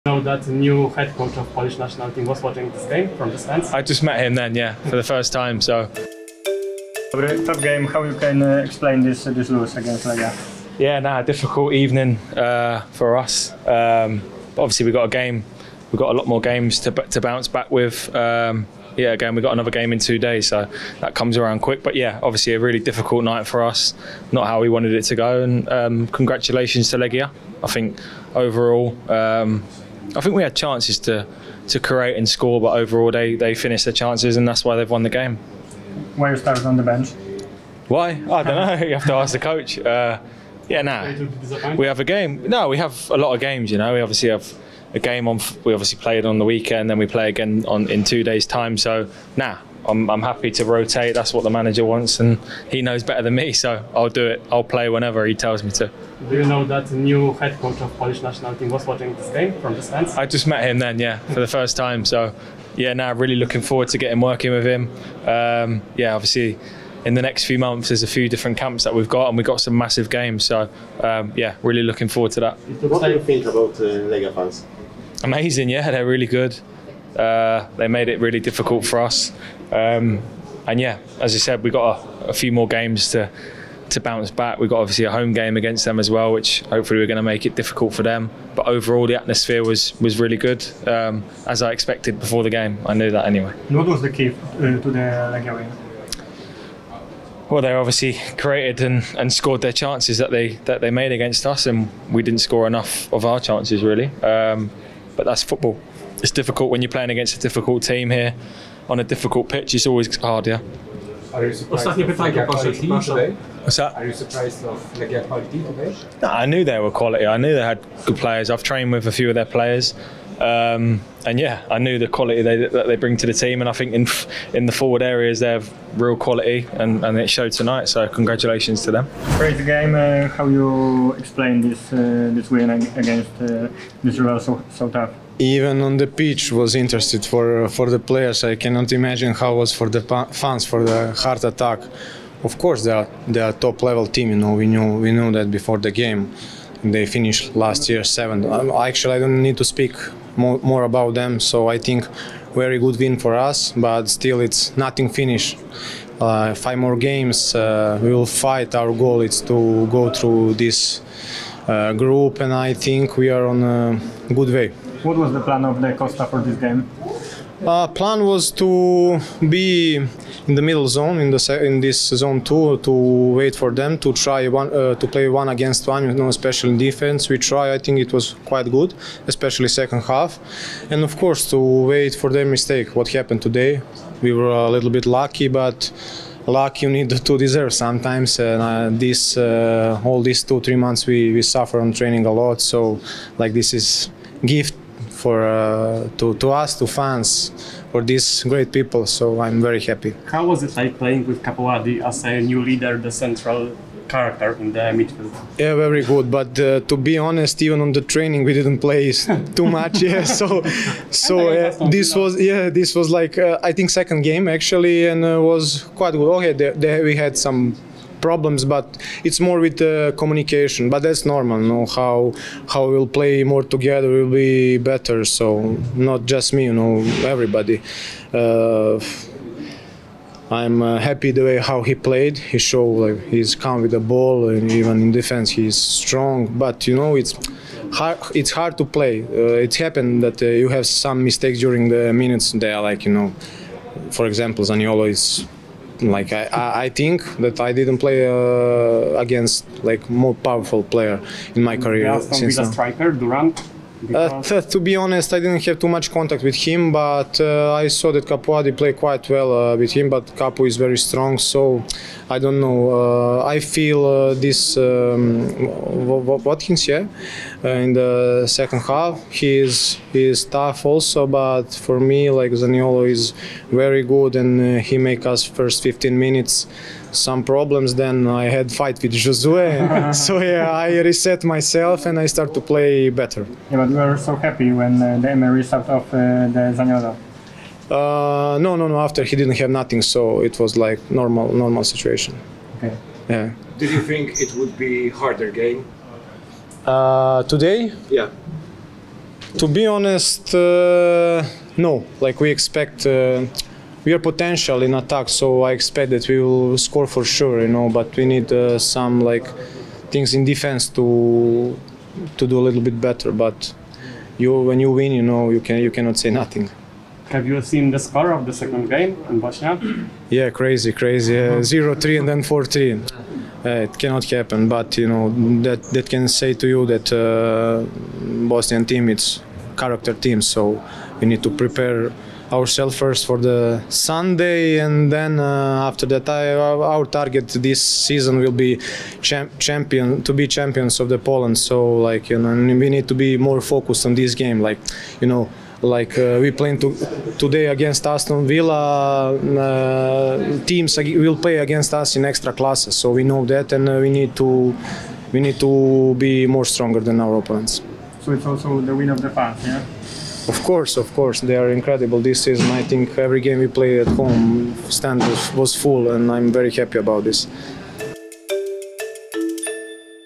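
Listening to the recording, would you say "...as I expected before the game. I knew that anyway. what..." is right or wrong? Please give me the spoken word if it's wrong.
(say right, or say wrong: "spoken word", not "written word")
right.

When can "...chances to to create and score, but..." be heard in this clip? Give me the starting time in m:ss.
0:30.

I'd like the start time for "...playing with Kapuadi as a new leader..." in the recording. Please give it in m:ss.
3:20.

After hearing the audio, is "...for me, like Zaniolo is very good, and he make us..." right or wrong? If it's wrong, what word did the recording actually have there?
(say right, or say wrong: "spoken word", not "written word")
right.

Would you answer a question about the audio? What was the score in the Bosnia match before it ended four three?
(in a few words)
0-3.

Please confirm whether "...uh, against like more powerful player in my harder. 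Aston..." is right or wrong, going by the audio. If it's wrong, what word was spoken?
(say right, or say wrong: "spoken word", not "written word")
wrong: "career", not "harder".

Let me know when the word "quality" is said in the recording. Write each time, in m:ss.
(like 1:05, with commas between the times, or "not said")
1:56, 2:02, 2:06.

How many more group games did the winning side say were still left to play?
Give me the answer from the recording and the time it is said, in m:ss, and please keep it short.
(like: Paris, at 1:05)
5, at 2:36.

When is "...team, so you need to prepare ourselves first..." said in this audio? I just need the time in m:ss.
5:30.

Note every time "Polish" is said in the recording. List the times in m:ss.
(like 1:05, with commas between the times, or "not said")
0:01, 0:57.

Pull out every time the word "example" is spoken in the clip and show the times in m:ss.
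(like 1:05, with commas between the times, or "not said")
4:04.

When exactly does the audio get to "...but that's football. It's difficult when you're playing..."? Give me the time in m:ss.
1:45.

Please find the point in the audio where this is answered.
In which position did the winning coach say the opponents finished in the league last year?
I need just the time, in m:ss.
2:28.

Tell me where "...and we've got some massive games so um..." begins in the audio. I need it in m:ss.
1:09.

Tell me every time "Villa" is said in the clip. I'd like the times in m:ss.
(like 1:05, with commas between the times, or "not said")
4:12, 5:48.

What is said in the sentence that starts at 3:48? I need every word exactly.
Uh, I'm uh, happy the way how he played.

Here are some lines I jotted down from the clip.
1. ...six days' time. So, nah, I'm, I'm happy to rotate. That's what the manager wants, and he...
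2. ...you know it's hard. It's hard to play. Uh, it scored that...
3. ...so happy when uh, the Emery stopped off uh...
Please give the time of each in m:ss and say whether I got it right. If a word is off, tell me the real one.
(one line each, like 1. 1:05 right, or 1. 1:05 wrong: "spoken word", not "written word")
1. 0:48 wrong: "two", not "six"
2. 3:56 wrong: "happened", not "scored"
3. 4:44 right.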